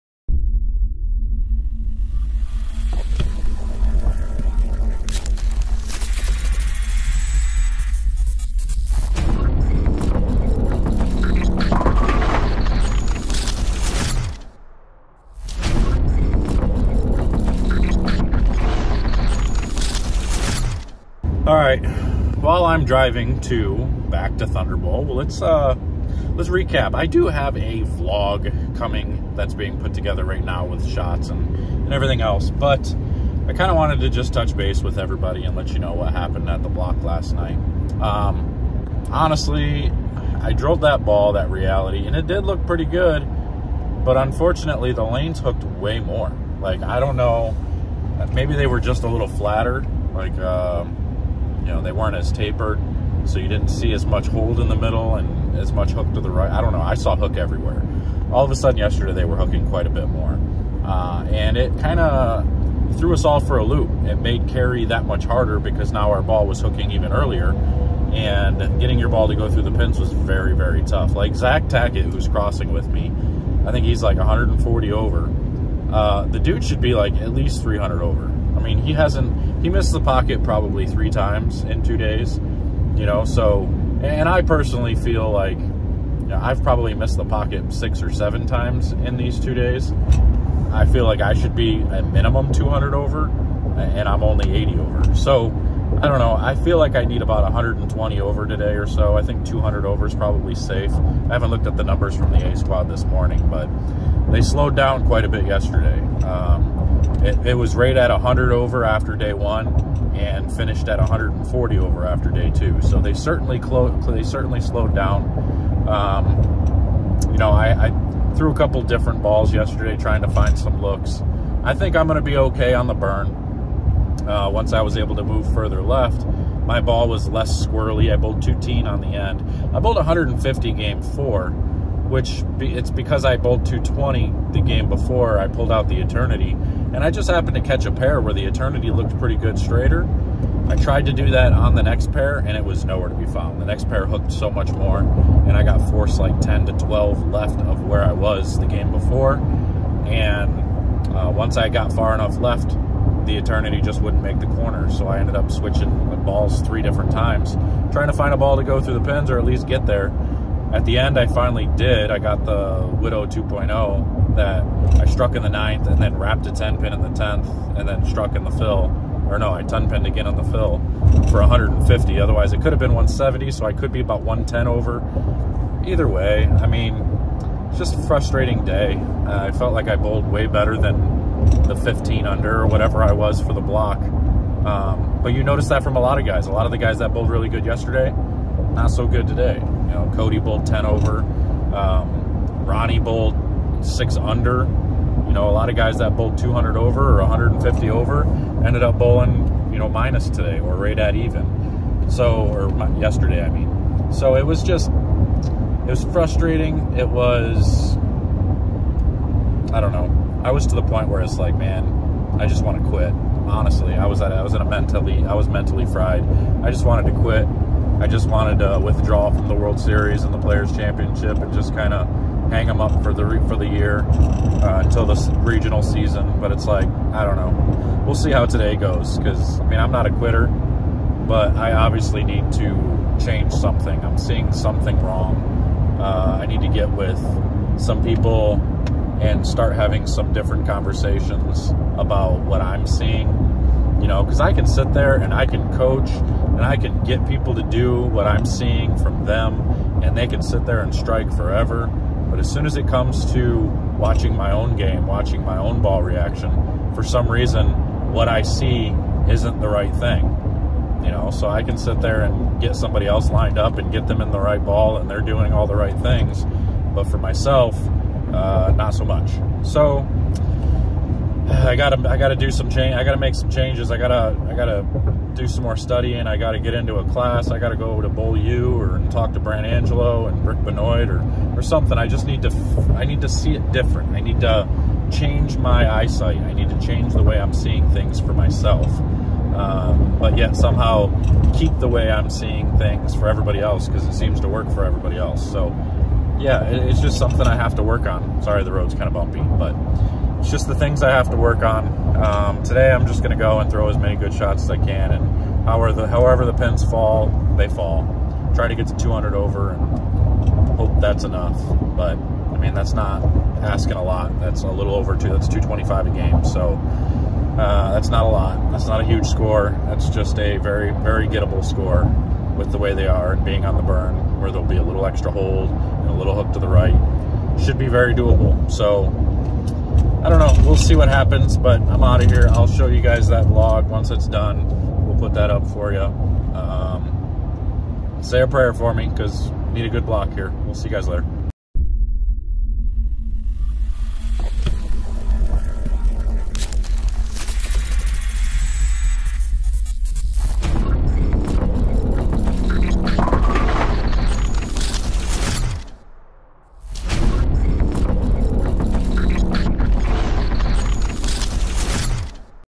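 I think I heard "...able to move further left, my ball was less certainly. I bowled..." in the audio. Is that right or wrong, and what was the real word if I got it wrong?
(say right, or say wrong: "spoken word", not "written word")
wrong: "squirrely", not "certainly".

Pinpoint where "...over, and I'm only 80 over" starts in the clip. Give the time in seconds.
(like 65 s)
92 s.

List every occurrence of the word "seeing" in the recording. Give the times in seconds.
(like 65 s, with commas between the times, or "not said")
234 s, 242 s, 248 s, 287 s, 292 s.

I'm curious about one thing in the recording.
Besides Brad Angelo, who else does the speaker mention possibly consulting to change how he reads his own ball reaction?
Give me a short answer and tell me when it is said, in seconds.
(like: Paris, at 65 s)
Rick Benoit, at 280 s.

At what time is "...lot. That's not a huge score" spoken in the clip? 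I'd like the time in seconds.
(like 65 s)
318 s.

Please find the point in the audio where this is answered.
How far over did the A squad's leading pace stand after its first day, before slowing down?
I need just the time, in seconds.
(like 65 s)
108 s.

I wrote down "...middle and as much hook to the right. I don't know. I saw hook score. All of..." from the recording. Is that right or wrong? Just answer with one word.
wrong.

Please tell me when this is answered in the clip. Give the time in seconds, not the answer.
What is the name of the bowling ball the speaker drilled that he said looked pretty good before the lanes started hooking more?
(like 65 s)
41 s.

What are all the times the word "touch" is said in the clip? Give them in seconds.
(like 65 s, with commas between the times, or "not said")
34 s.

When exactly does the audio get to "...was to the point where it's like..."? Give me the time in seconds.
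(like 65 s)
210 s.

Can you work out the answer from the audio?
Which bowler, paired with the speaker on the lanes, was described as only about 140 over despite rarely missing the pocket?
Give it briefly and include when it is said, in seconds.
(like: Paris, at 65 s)
Zach Tackett, at 71 s.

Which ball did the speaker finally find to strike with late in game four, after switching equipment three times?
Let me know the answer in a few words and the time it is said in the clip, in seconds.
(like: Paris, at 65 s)
Widow 2.0, at 163 s.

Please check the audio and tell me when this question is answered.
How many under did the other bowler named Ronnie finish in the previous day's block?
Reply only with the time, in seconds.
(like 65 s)
193 s.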